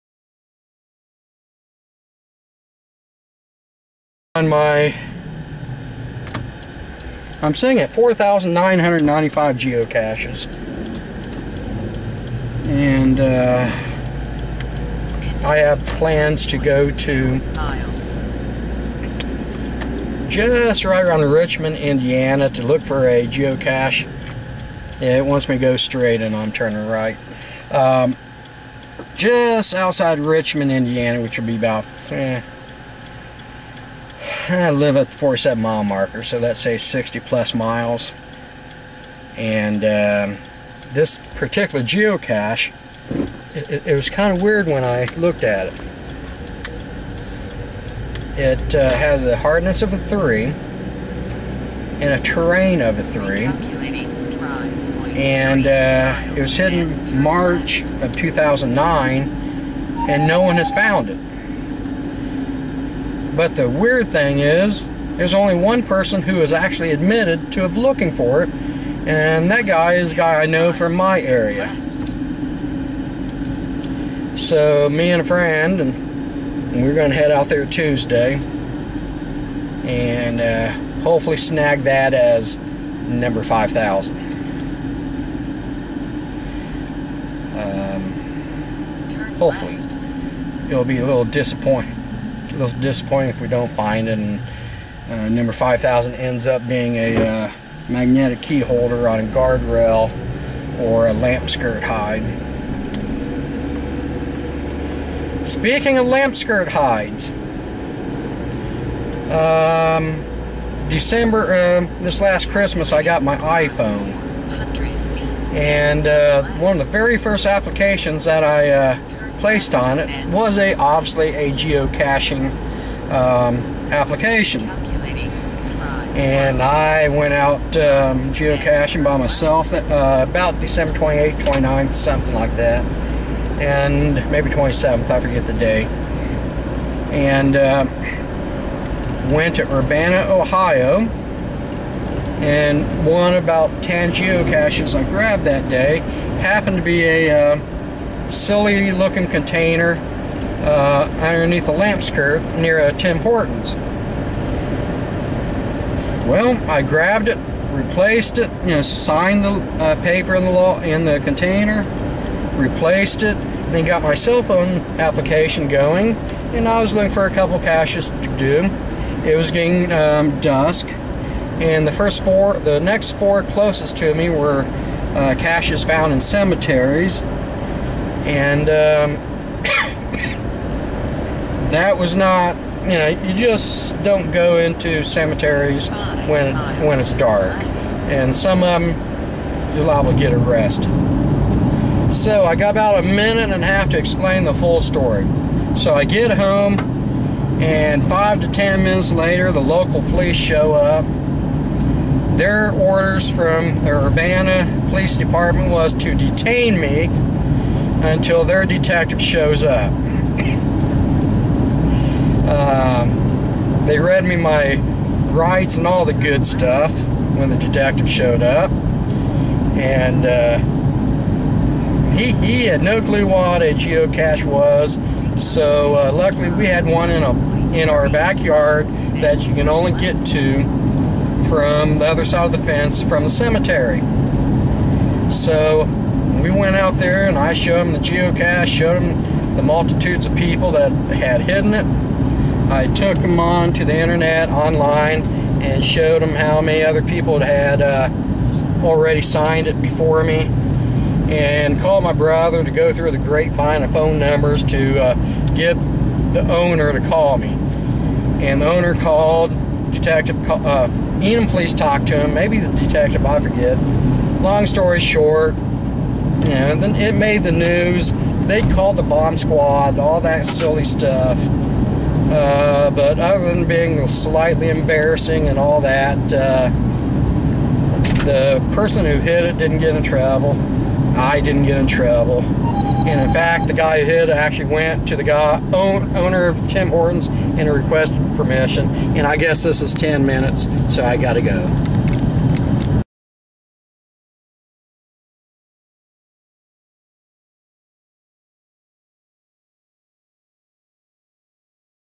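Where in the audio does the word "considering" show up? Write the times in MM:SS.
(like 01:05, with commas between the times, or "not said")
not said.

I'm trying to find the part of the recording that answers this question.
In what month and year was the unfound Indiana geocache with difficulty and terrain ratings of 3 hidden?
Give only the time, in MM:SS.
00:57.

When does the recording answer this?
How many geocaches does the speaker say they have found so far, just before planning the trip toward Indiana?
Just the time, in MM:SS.
00:07.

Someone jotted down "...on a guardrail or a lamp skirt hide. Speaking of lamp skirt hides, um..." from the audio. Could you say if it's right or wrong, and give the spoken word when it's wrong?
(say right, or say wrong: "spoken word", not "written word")
right.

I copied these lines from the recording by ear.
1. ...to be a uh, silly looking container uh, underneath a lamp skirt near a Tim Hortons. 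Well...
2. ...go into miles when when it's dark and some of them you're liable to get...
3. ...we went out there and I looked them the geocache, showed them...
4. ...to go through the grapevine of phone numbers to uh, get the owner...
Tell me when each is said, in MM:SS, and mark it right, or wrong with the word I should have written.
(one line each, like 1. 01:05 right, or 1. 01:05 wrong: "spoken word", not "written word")
1. 02:26 right
2. 03:04 wrong: "cemeteries", not "miles"
3. 03:56 wrong: "showed", not "looked"
4. 04:12 right.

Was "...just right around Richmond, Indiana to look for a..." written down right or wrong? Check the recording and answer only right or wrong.
right.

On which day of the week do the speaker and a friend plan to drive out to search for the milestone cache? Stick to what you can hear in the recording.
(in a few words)
Tuesday.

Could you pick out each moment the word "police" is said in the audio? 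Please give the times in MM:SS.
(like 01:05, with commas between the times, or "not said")
03:20, 03:24, 04:21.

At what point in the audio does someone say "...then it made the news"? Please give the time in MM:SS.
04:26.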